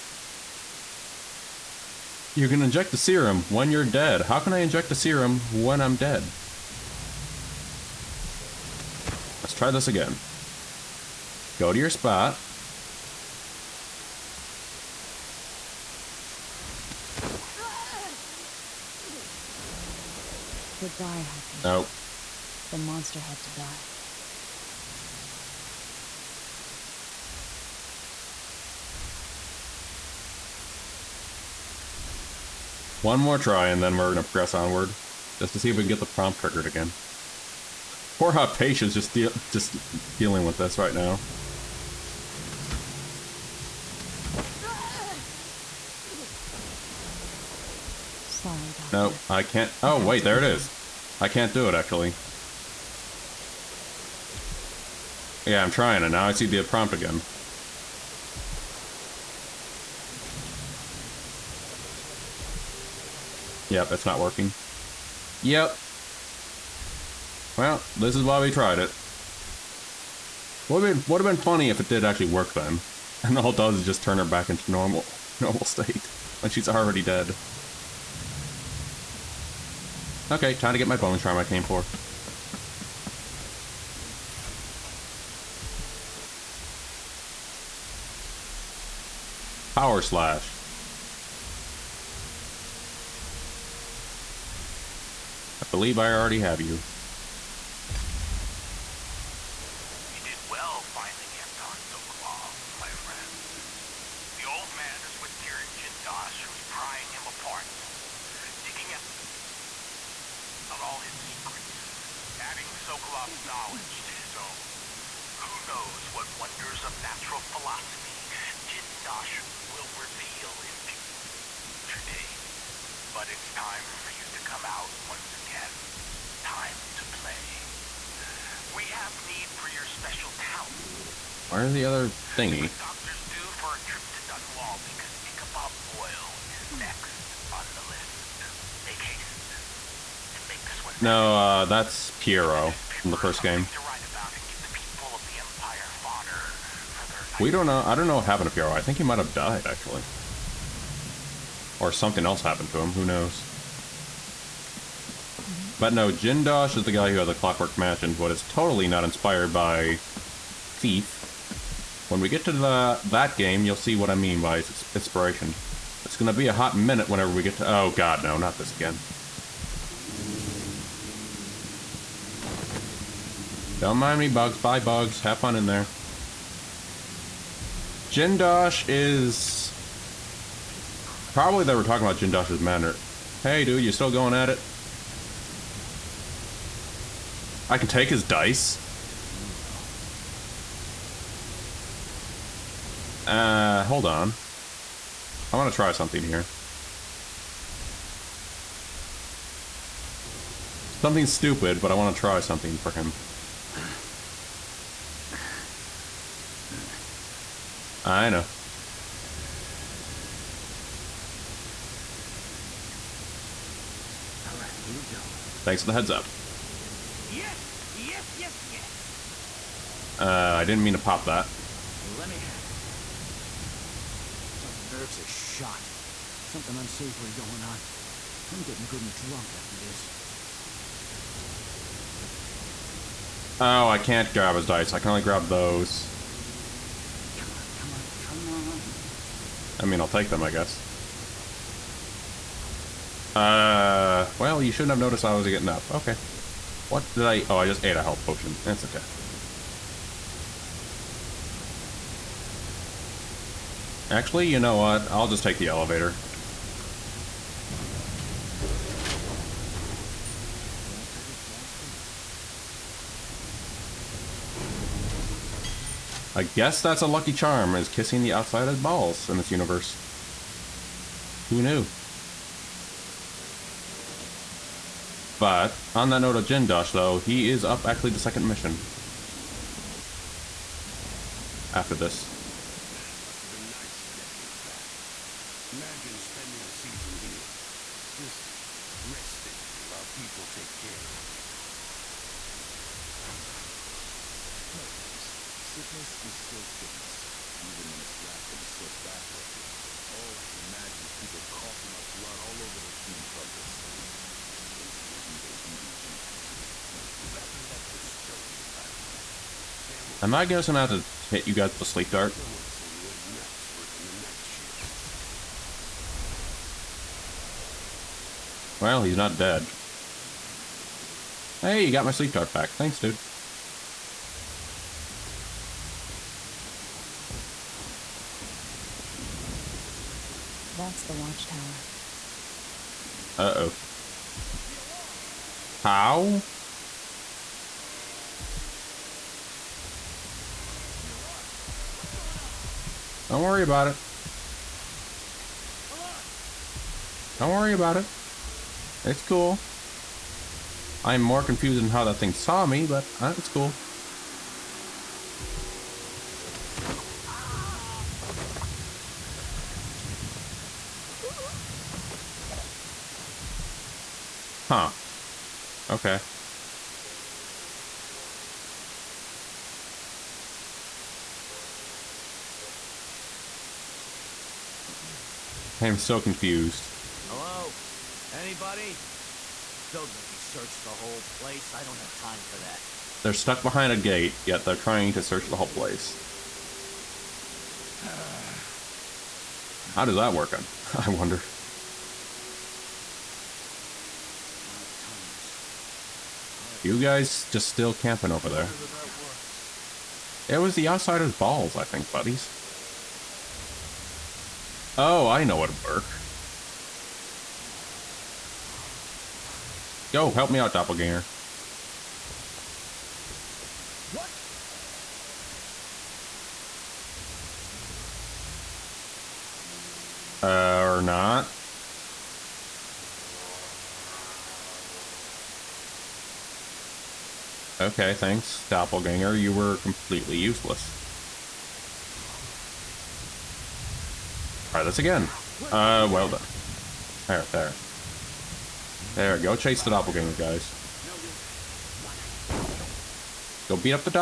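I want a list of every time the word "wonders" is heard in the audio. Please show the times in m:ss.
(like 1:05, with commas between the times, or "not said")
1:56, 6:31.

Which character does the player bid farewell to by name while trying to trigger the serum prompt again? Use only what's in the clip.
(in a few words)
Hypatia.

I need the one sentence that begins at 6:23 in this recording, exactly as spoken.
They're stuck behind a gate, yet they're trying to search the whole place.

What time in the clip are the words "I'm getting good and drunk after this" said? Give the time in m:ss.
3:48.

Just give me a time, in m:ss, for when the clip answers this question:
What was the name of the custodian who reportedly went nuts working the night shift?
5:09.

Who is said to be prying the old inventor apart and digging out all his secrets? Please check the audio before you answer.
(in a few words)
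Kirin Jindosh.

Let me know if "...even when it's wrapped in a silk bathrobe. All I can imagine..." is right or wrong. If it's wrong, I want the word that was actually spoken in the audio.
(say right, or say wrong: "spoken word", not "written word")
right.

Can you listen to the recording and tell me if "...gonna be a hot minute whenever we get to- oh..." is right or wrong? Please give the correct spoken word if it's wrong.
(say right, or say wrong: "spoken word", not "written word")
right.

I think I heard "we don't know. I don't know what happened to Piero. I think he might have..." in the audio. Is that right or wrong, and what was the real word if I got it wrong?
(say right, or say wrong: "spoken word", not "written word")
right.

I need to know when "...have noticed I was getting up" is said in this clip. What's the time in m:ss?
4:04.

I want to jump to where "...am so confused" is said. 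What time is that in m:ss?
6:15.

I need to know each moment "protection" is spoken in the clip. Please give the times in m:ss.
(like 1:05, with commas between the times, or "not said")
not said.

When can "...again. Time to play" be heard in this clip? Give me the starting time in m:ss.
2:05.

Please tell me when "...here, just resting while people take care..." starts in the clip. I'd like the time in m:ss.
4:47.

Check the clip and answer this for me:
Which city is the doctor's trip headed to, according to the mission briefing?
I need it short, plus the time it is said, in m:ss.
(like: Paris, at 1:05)
Dunwall, at 2:14.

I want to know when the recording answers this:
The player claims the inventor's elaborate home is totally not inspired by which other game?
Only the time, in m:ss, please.
2:40.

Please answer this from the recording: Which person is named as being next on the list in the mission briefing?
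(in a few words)
Ichabod Boyle.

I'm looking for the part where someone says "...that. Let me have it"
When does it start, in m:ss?
3:41.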